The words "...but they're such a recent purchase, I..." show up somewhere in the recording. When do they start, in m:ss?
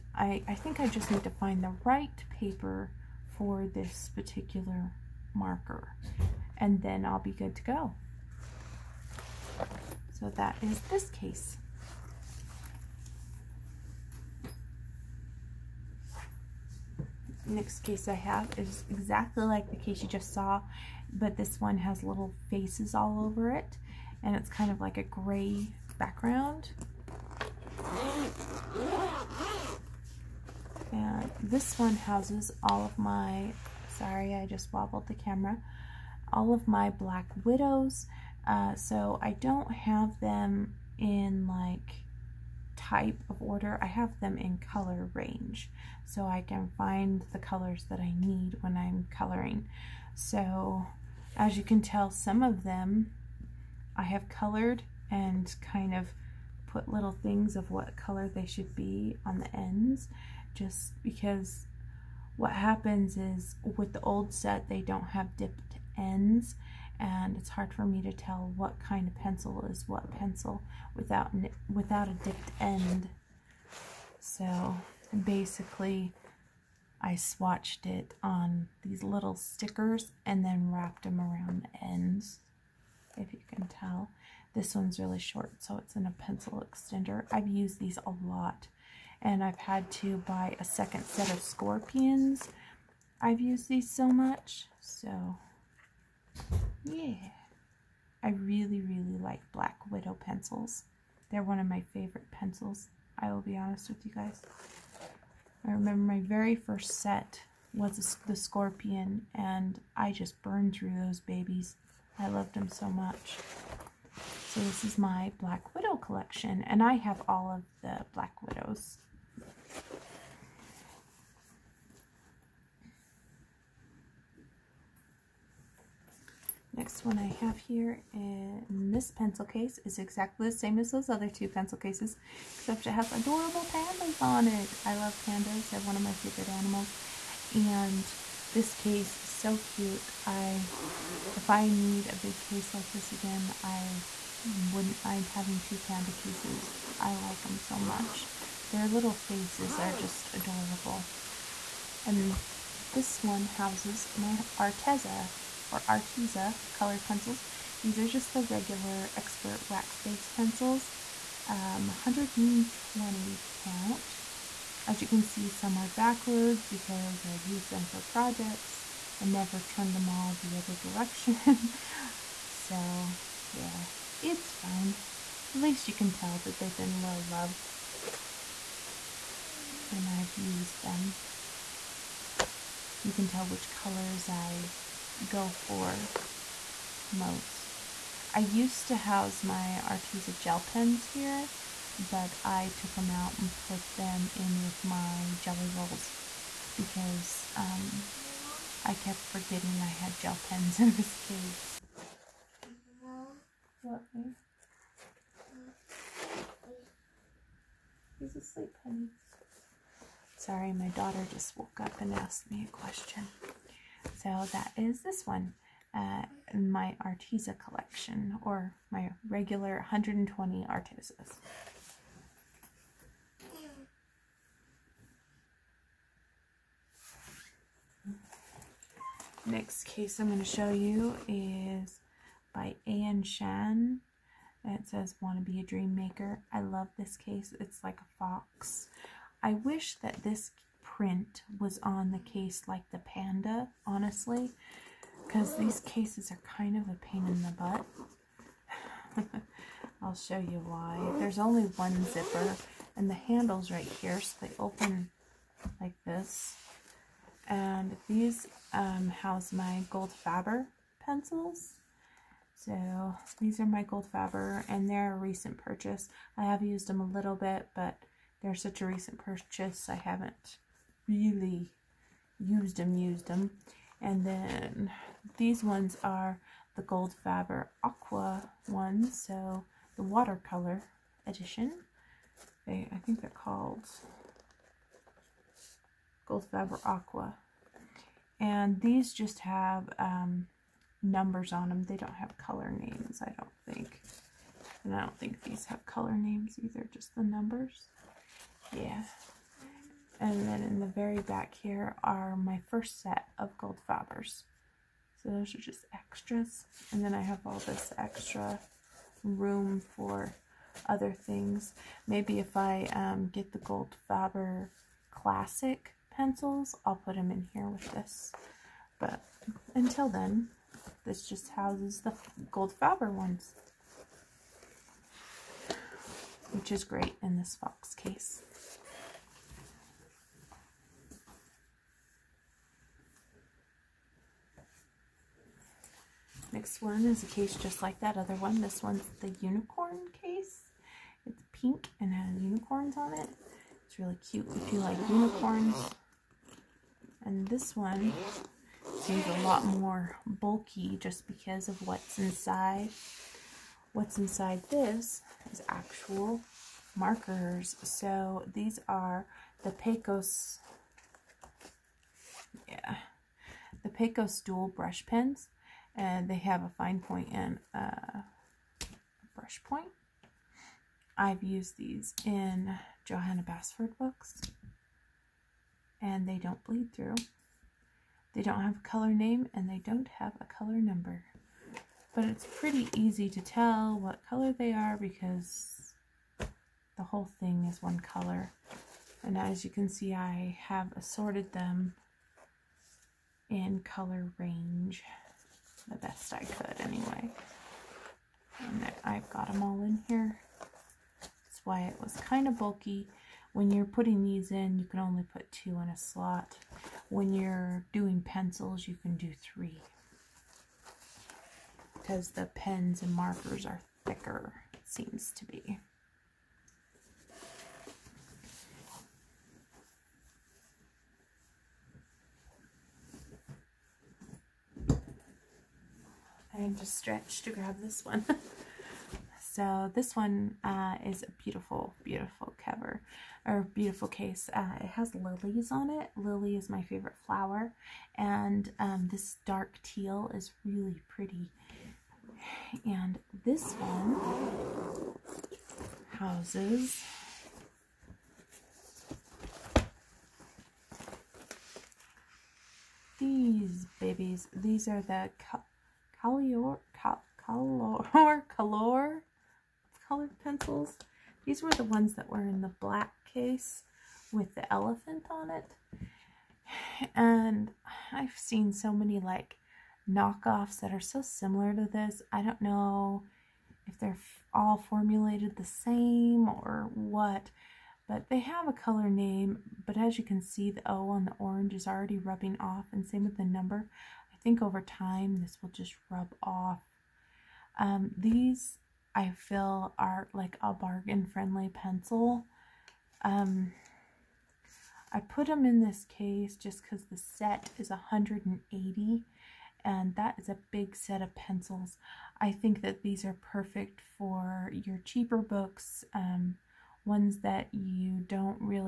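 4:27.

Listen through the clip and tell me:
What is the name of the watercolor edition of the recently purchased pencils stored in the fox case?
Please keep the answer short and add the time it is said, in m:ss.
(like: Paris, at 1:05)
Goldfaber Aqua, at 4:46.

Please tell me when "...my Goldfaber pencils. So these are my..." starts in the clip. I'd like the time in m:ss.
4:19.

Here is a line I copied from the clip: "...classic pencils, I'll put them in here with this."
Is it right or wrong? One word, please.
right.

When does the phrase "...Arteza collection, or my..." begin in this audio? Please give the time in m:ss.
3:37.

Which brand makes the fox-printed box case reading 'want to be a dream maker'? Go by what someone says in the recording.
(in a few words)
Anne Shan.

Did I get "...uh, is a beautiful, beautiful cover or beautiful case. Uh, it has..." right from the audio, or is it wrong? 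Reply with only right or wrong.
right.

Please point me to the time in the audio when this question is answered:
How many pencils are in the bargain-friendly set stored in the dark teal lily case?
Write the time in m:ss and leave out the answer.
8:17.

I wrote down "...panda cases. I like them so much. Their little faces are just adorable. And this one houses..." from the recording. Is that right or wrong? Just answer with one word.
right.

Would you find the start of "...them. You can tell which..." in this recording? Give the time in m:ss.
3:00.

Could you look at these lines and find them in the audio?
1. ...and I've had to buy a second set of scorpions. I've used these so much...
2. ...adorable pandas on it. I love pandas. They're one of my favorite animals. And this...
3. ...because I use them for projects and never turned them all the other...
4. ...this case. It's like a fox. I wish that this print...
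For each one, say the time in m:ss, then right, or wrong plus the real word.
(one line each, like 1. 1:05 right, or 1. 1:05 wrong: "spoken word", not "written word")
1. 1:29 right
2. 2:13 right
3. 2:46 right
4. 3:56 right.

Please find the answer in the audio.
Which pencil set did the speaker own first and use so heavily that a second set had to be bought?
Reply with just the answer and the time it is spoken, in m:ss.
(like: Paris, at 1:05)
Scorpion, at 1:48.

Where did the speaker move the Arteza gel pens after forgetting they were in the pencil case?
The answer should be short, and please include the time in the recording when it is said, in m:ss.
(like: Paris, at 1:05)
with my jelly rolls, at 3:14.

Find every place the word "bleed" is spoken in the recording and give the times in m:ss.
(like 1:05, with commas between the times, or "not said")
6:16.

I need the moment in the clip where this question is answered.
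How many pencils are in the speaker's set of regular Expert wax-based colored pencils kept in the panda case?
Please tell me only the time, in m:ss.
2:41.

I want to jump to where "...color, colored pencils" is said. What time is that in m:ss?
7:38.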